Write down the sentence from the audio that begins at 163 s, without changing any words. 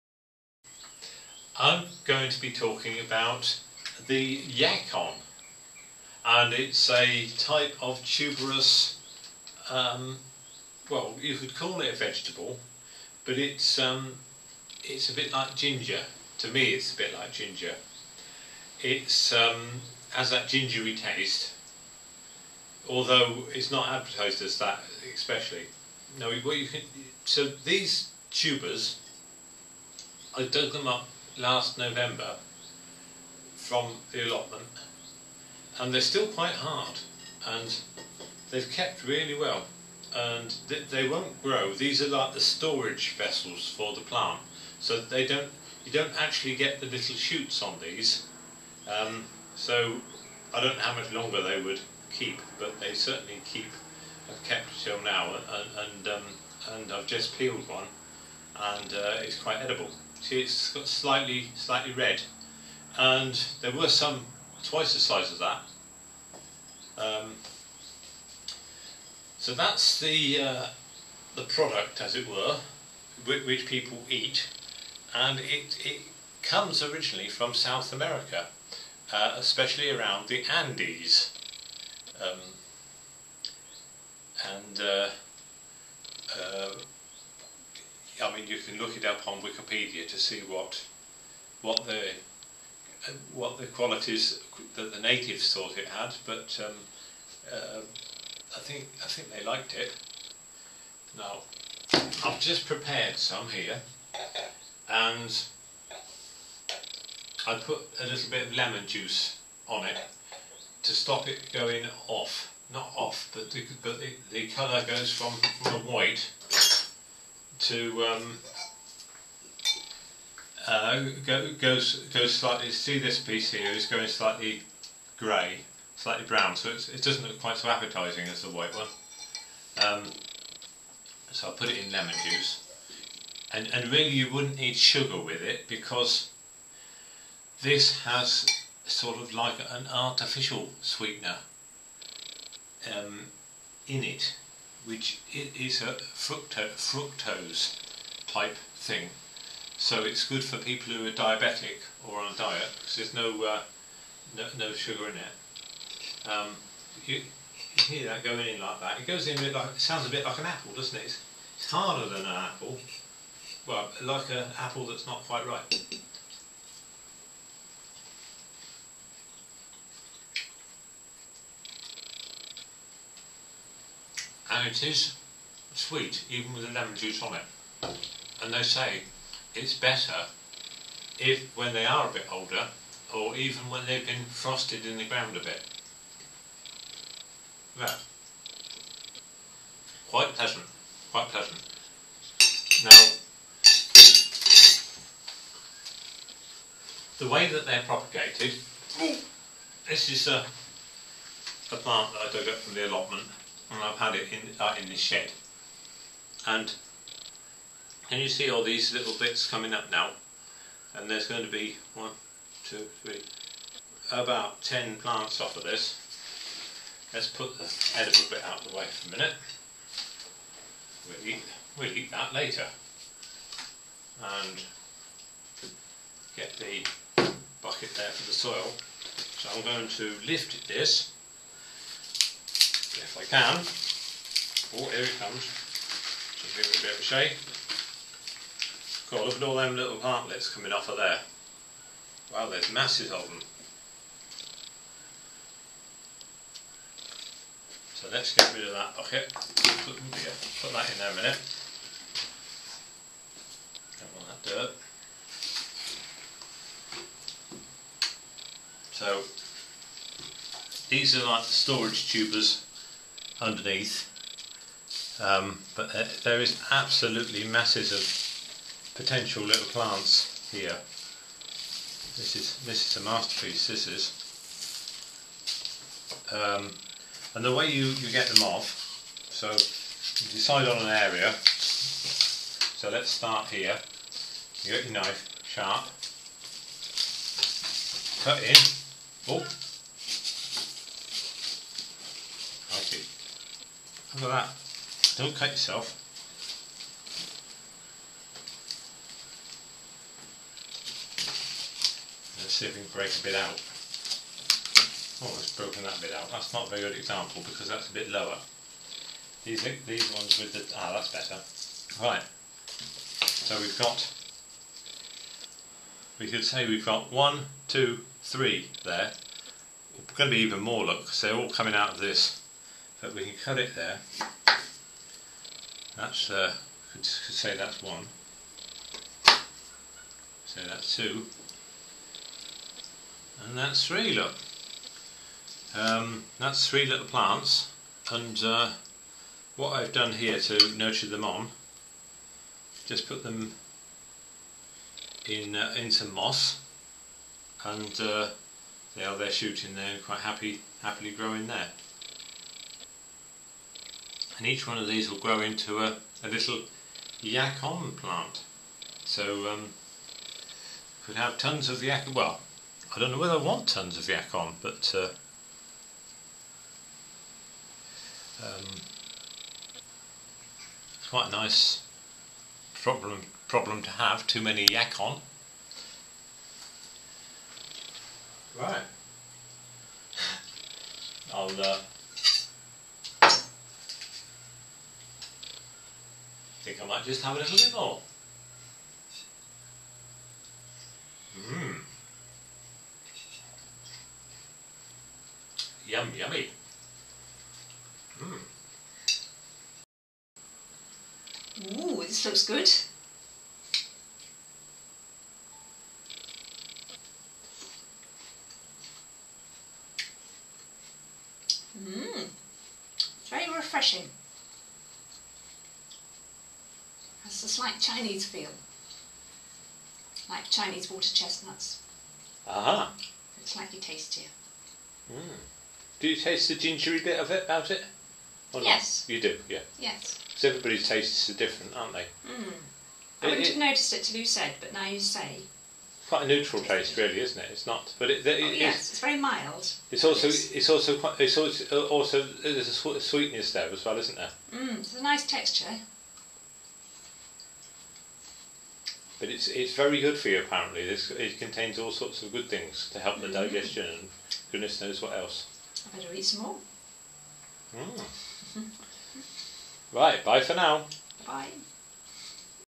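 Well, like an apple that's not quite ripe.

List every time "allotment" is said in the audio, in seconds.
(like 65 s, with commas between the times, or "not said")
34 s, 202 s.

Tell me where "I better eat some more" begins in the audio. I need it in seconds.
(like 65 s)
455 s.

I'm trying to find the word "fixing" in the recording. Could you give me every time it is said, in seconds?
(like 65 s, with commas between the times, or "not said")
not said.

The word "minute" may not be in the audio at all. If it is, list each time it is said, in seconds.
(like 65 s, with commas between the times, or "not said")
219 s, 251 s.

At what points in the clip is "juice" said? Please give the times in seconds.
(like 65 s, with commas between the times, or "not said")
108 s, 132 s, 176 s.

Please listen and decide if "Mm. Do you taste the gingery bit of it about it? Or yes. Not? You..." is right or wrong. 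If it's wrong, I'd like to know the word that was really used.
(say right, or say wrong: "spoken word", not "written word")
right.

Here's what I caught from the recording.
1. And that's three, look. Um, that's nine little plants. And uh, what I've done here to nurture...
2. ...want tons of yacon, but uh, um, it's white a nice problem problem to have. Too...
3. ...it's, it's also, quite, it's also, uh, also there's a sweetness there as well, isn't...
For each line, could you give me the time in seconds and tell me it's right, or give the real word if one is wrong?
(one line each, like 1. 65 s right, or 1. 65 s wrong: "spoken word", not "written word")
1. 333 s wrong: "three", not "nine"
2. 363 s wrong: "quite", not "white"
3. 440 s right.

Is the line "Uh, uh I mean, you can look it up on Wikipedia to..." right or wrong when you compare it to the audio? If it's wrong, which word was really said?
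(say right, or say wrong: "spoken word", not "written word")
right.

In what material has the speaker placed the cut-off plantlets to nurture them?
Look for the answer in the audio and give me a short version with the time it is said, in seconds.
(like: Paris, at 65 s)
Moss, at 346 s.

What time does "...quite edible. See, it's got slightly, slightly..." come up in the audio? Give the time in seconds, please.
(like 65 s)
59 s.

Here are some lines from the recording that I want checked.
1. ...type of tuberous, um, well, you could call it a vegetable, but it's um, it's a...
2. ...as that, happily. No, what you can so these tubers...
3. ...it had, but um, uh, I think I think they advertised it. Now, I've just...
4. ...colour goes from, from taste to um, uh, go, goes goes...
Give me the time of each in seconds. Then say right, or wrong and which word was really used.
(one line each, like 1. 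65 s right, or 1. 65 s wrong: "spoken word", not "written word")
1. 7 s right
2. 24 s wrong: "especially", not "happily"
3. 95 s wrong: "liked", not "advertised"
4. 114 s wrong: "white", not "taste".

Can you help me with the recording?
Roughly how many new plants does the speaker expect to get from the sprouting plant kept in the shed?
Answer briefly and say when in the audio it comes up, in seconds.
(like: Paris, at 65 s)
About 10, at 214 s.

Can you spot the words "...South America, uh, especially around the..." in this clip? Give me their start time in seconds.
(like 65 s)
77 s.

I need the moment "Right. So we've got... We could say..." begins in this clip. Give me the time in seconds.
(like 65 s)
312 s.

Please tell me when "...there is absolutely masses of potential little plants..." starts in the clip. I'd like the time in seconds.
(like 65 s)
266 s.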